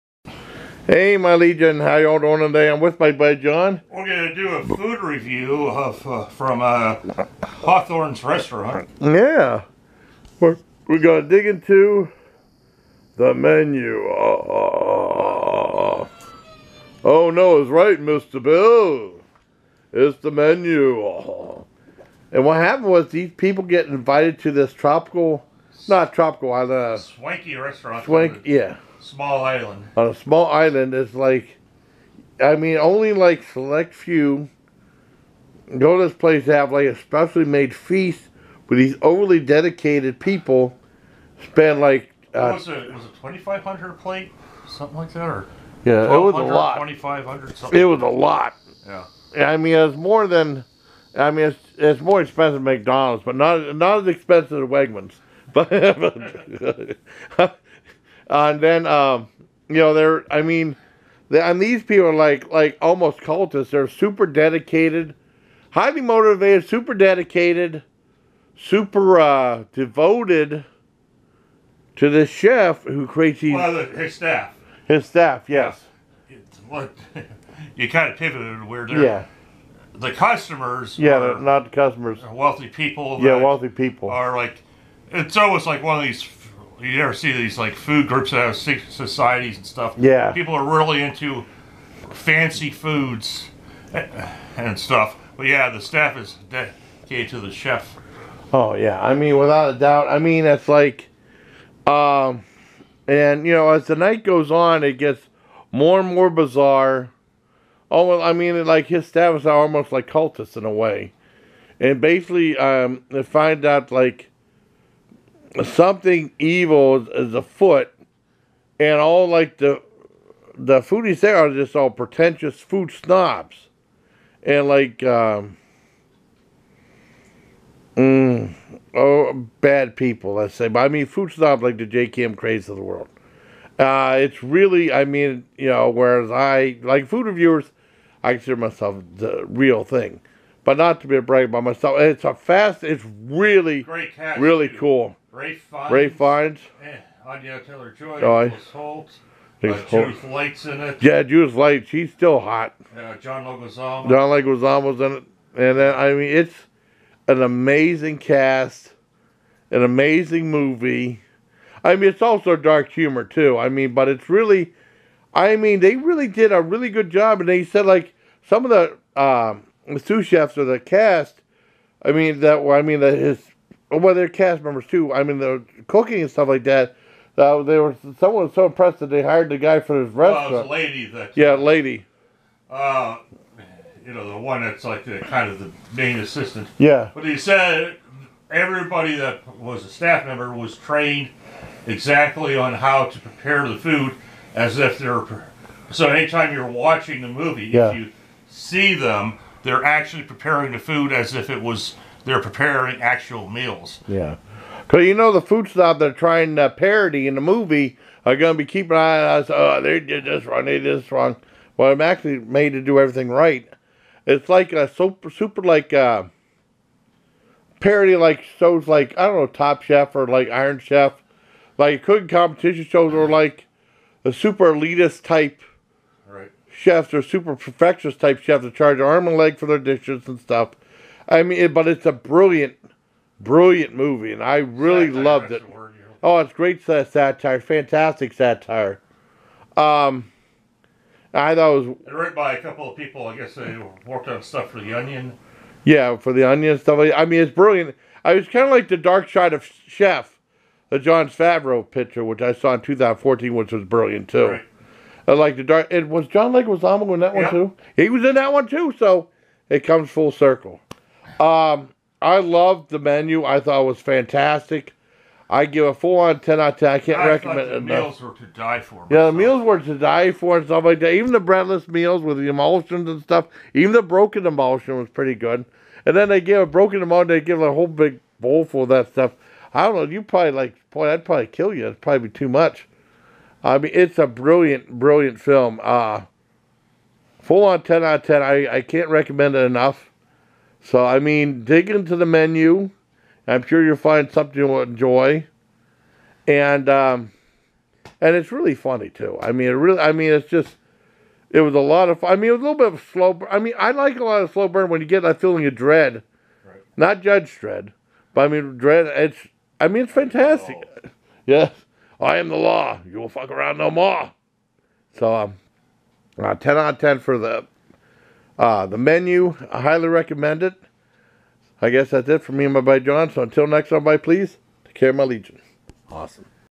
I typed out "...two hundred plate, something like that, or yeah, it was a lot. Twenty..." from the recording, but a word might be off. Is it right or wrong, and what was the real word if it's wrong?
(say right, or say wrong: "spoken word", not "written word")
wrong: "five", not "two".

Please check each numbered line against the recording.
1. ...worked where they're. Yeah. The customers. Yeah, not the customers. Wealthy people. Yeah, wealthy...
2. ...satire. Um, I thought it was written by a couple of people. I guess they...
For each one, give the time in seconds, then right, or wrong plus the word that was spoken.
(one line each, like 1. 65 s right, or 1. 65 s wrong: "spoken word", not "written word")
1. 78 s wrong: "pivoted", not "worked"
2. 238 s right.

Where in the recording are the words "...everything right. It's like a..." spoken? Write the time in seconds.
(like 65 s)
212 s.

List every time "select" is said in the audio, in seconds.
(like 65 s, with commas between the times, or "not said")
33 s.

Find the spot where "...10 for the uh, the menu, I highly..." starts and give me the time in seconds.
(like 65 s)
316 s.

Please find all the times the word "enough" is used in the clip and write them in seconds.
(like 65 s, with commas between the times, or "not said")
267 s, 289 s.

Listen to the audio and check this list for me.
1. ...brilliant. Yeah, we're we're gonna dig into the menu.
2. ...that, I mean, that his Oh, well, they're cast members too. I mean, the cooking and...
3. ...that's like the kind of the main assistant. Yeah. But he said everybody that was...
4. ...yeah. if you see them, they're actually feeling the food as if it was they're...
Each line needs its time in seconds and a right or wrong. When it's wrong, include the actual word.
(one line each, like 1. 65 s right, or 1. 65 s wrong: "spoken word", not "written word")
1. 8 s wrong: "restaurant", not "brilliant"
2. 172 s right
3. 184 s right
4. 197 s wrong: "preparing", not "feeling".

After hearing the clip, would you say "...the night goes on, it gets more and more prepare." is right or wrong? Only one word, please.
wrong.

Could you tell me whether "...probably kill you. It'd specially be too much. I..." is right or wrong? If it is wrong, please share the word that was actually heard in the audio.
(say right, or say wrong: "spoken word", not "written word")
wrong: "probably", not "specially".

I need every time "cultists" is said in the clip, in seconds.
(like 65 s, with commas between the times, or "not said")
63 s, 110 s.